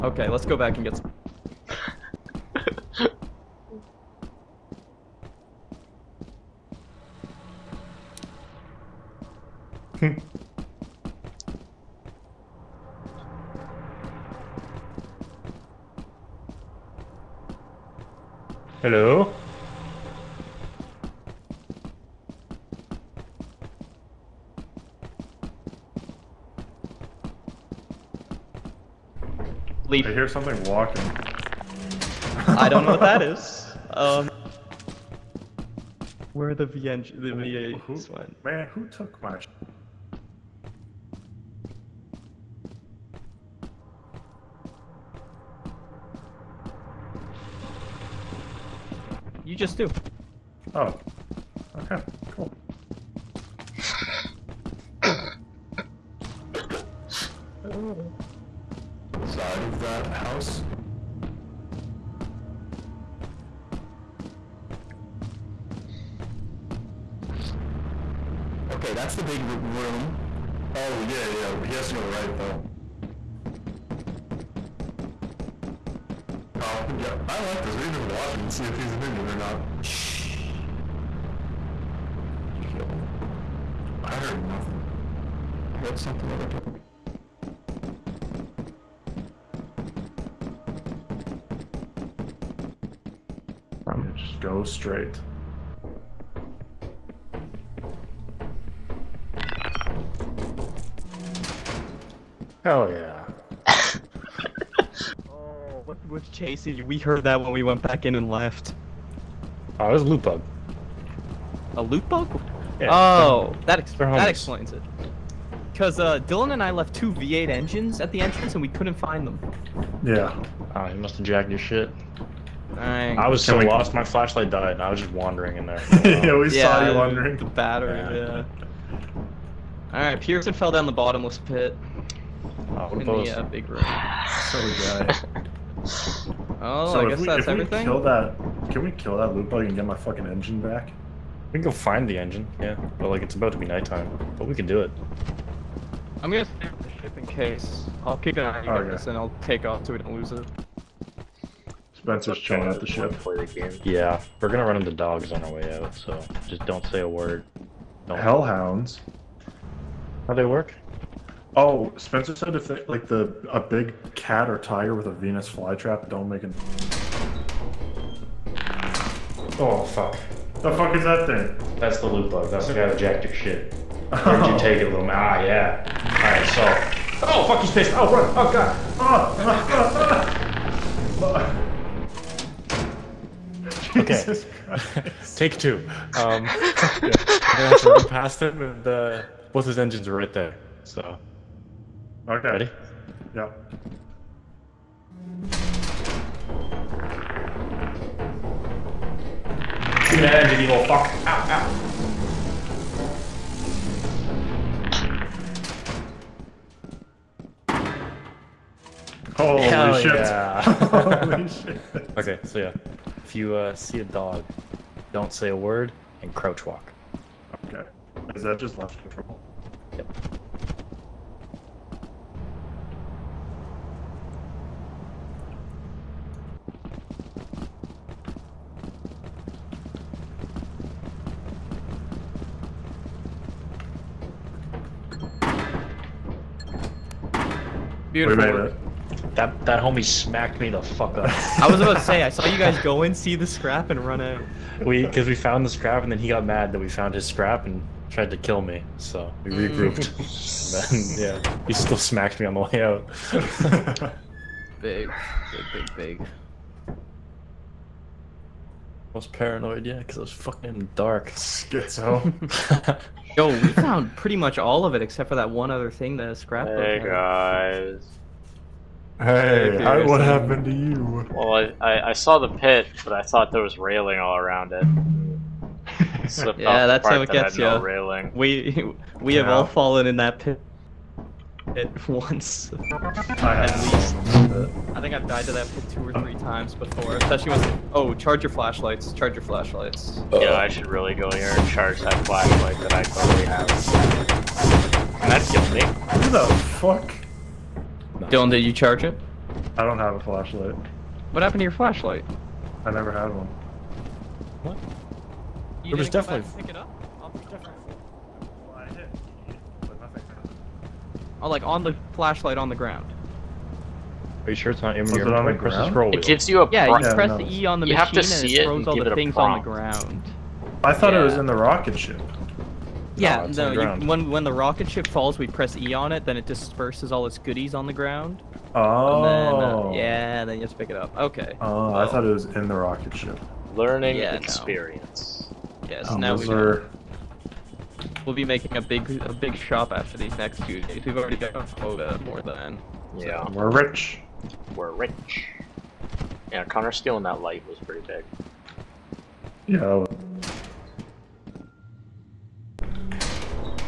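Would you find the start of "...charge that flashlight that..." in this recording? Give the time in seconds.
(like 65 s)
291 s.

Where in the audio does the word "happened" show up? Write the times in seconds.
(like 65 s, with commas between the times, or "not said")
270 s, 301 s.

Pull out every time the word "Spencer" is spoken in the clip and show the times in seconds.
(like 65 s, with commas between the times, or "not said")
151 s, 161 s.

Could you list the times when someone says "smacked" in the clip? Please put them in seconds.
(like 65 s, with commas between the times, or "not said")
240 s, 251 s.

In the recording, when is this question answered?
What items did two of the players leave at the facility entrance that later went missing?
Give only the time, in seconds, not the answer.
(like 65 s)
116 s.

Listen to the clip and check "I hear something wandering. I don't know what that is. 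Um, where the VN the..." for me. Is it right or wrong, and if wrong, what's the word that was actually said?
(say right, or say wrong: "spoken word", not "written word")
wrong: "walking", not "wandering".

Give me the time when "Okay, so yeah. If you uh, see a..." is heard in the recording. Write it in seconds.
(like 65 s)
212 s.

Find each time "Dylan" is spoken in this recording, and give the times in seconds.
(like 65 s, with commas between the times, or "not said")
116 s, 298 s.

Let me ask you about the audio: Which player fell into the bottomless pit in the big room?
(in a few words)
Pearson.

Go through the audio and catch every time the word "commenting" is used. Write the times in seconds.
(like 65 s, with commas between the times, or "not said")
not said.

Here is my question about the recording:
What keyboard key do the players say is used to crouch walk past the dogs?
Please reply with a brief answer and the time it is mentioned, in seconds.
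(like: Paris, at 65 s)
Left control, at 218 s.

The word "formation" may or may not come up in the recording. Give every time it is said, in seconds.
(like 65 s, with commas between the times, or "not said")
not said.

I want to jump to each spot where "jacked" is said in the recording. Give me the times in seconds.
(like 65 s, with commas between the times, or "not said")
121 s, 172 s.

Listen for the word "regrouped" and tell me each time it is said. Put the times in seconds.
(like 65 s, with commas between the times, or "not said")
249 s.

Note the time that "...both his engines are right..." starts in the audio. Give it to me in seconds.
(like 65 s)
189 s.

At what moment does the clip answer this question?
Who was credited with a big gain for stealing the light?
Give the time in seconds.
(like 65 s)
346 s.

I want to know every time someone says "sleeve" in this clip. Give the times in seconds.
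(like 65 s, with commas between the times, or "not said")
not said.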